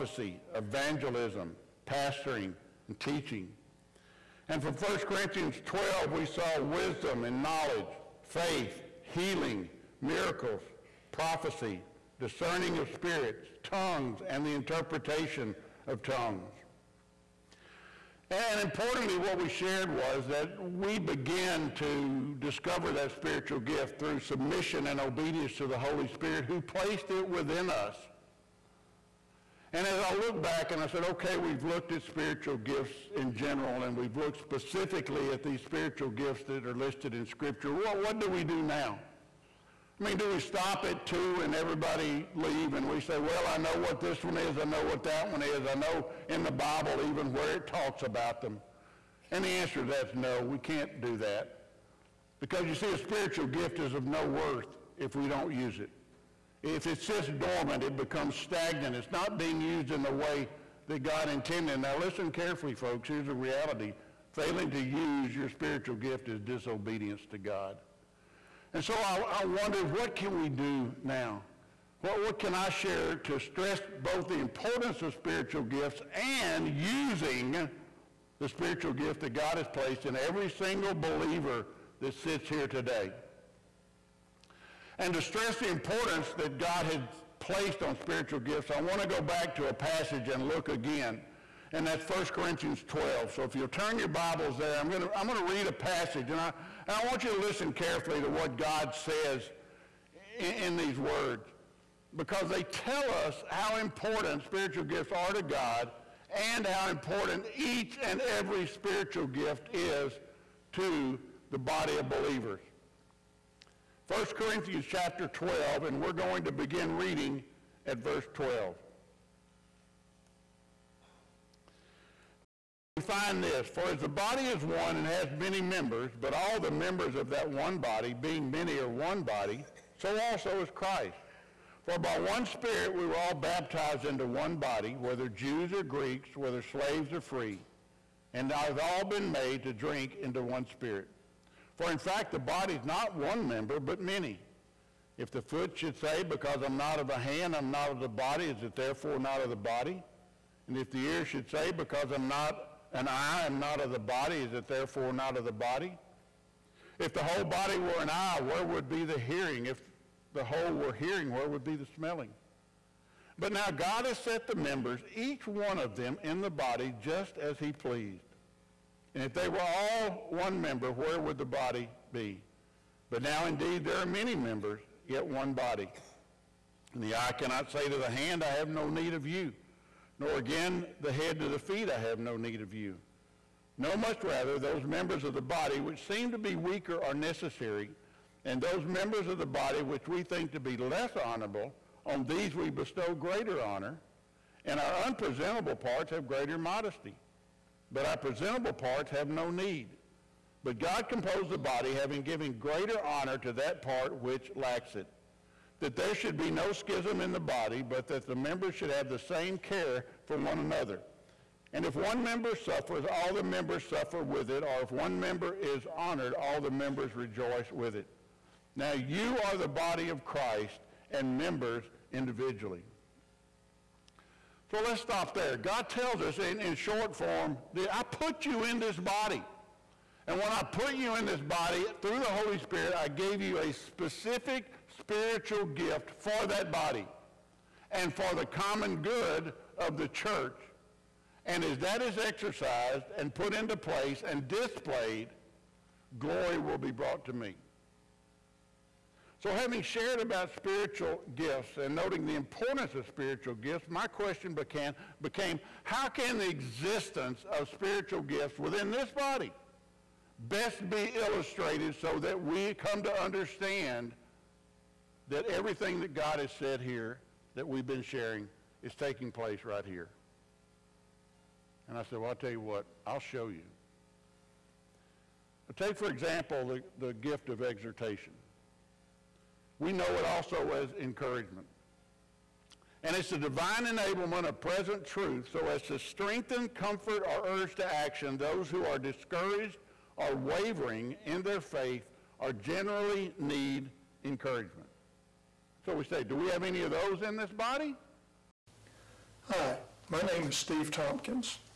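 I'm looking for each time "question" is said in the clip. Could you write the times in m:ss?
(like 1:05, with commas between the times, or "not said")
4:14.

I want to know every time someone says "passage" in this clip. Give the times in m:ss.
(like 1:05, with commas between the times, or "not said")
1:29, 1:35.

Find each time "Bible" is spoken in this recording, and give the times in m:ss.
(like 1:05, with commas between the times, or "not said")
0:46, 1:34.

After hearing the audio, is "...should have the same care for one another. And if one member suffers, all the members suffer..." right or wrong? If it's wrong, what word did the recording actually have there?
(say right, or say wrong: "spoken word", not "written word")
right.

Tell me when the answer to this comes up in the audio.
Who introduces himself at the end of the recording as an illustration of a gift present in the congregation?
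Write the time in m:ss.
5:00.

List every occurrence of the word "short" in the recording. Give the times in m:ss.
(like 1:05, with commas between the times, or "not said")
3:46.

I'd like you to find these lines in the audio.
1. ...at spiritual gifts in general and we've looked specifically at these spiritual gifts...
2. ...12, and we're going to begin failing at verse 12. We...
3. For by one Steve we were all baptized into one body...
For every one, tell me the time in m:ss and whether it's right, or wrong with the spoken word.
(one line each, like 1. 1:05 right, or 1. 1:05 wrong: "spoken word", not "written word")
1. 0:31 right
2. 1:55 wrong: "reading", not "failing"
3. 2:11 wrong: "Spirit", not "Steve".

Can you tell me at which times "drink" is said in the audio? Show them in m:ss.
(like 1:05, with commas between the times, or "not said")
2:19.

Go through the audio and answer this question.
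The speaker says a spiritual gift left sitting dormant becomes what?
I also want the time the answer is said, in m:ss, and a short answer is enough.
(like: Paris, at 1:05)
Stagnant, at 0:58.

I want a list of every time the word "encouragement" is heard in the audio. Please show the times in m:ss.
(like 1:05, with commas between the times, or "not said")
4:41, 4:54.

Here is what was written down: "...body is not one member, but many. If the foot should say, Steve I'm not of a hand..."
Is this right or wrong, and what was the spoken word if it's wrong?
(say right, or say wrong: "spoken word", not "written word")
wrong: "Because", not "Steve".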